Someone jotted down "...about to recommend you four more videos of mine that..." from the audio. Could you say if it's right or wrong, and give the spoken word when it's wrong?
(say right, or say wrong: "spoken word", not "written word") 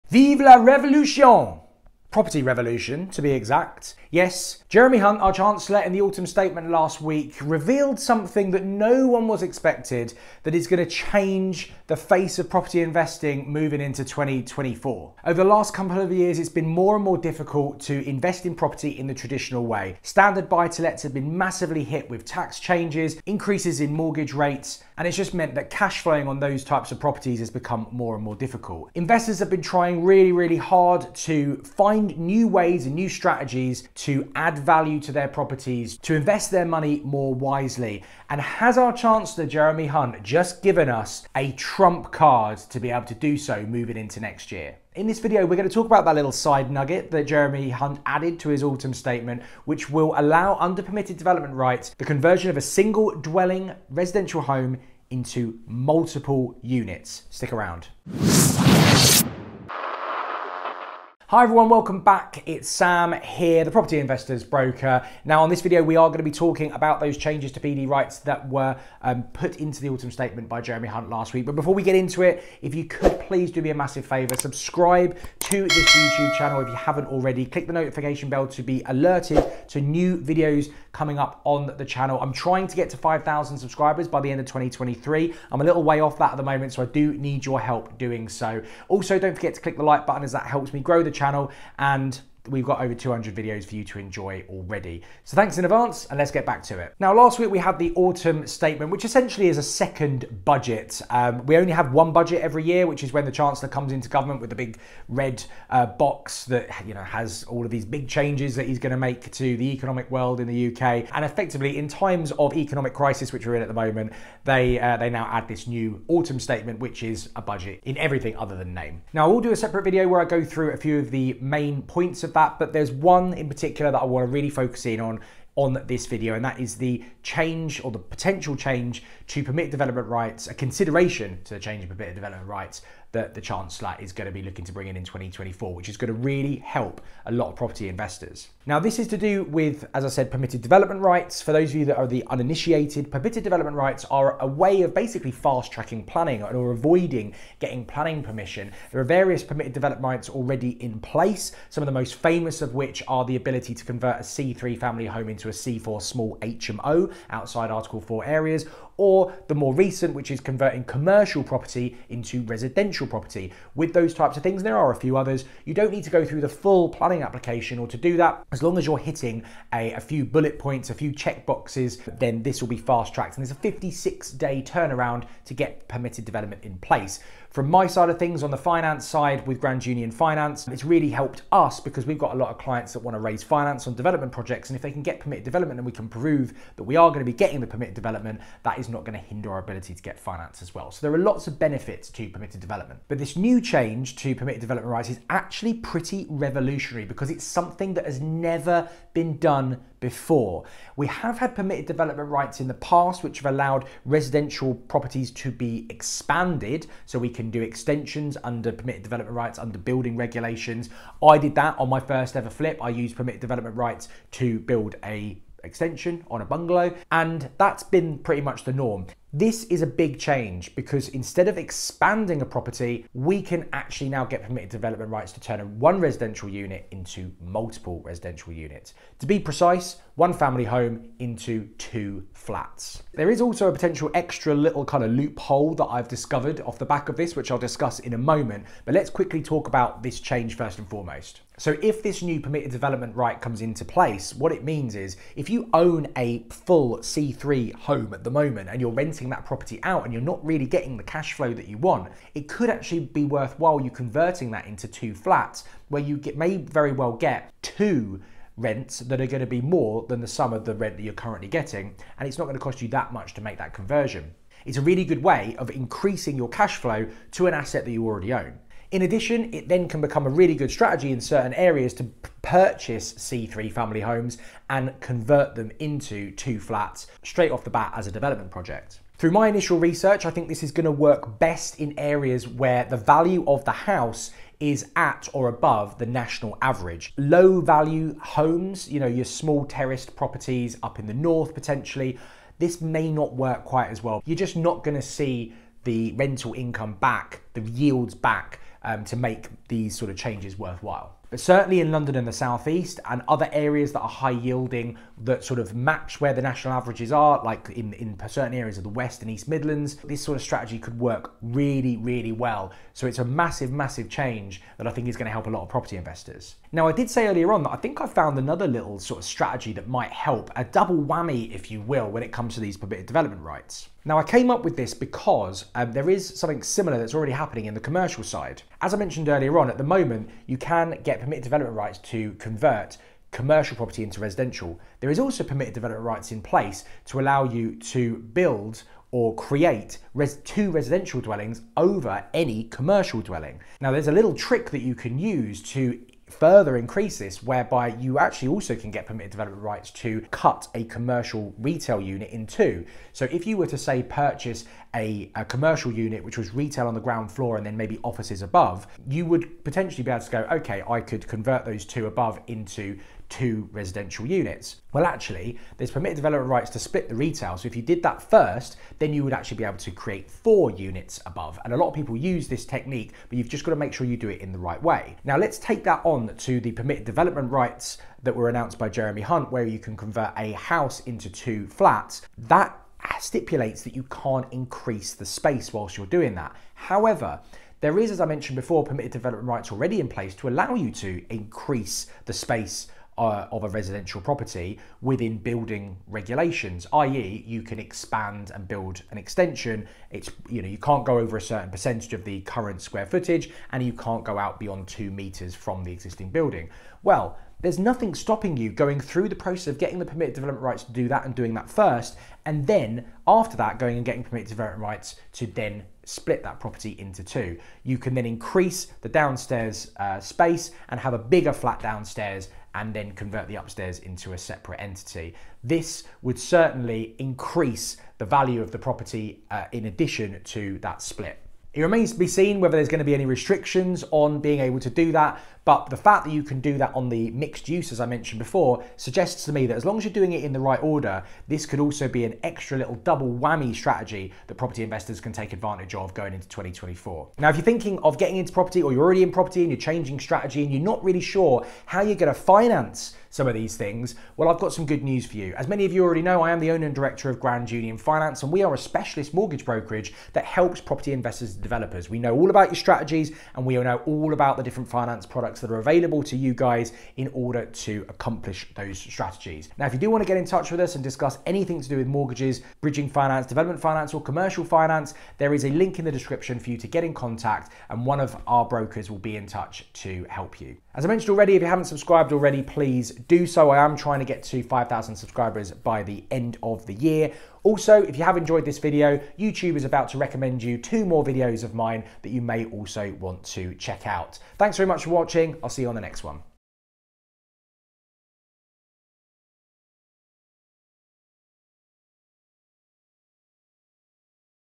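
wrong: "two", not "four".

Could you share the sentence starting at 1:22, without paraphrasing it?
I'm trying to get to 5,000 subscribers by the end of 2023.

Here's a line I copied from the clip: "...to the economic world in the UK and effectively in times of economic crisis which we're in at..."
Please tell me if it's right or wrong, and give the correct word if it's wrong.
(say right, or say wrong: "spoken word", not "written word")
right.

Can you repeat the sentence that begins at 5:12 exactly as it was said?
So it's a massive, massive change that I think is going to help a lot of property investors.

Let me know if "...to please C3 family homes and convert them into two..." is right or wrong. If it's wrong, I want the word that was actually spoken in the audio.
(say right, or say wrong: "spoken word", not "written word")
wrong: "purchase", not "please".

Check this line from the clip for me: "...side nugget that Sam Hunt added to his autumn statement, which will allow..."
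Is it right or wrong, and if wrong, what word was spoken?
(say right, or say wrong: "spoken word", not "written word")
wrong: "Jeremy", not "Sam".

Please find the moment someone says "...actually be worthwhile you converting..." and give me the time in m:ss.
4:12.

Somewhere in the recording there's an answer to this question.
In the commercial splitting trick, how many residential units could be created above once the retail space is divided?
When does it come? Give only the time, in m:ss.
6:10.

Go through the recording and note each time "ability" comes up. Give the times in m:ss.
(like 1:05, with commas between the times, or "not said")
2:33, 3:09.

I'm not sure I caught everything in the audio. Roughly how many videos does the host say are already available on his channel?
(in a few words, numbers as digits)
over 200.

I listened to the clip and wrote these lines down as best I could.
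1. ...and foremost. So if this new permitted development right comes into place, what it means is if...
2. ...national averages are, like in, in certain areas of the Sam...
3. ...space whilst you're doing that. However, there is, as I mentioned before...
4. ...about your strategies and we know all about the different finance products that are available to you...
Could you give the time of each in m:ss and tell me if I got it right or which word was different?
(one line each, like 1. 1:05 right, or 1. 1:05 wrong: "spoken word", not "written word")
1. 4:00 right
2. 5:06 wrong: "West", not "Sam"
3. 6:25 right
4. 7:42 right.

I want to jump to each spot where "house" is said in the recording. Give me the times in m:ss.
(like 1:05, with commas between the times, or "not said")
4:43, 6:20.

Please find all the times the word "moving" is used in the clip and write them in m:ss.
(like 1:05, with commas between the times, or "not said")
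0:13, 0:43.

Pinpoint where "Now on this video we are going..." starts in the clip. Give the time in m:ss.
1:05.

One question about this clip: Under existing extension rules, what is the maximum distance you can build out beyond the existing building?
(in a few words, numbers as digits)
2 meters.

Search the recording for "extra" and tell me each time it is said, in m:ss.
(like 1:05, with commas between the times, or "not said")
3:54, 7:22.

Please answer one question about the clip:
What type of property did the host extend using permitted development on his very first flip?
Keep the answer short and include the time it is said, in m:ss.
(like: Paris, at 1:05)
A bungalow, at 3:36.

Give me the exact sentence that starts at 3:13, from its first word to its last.
But this new change to permitted development rights is actually pretty revolutionary because it's something that has never been done before.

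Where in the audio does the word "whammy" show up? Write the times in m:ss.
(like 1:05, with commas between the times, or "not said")
5:20, 7:23.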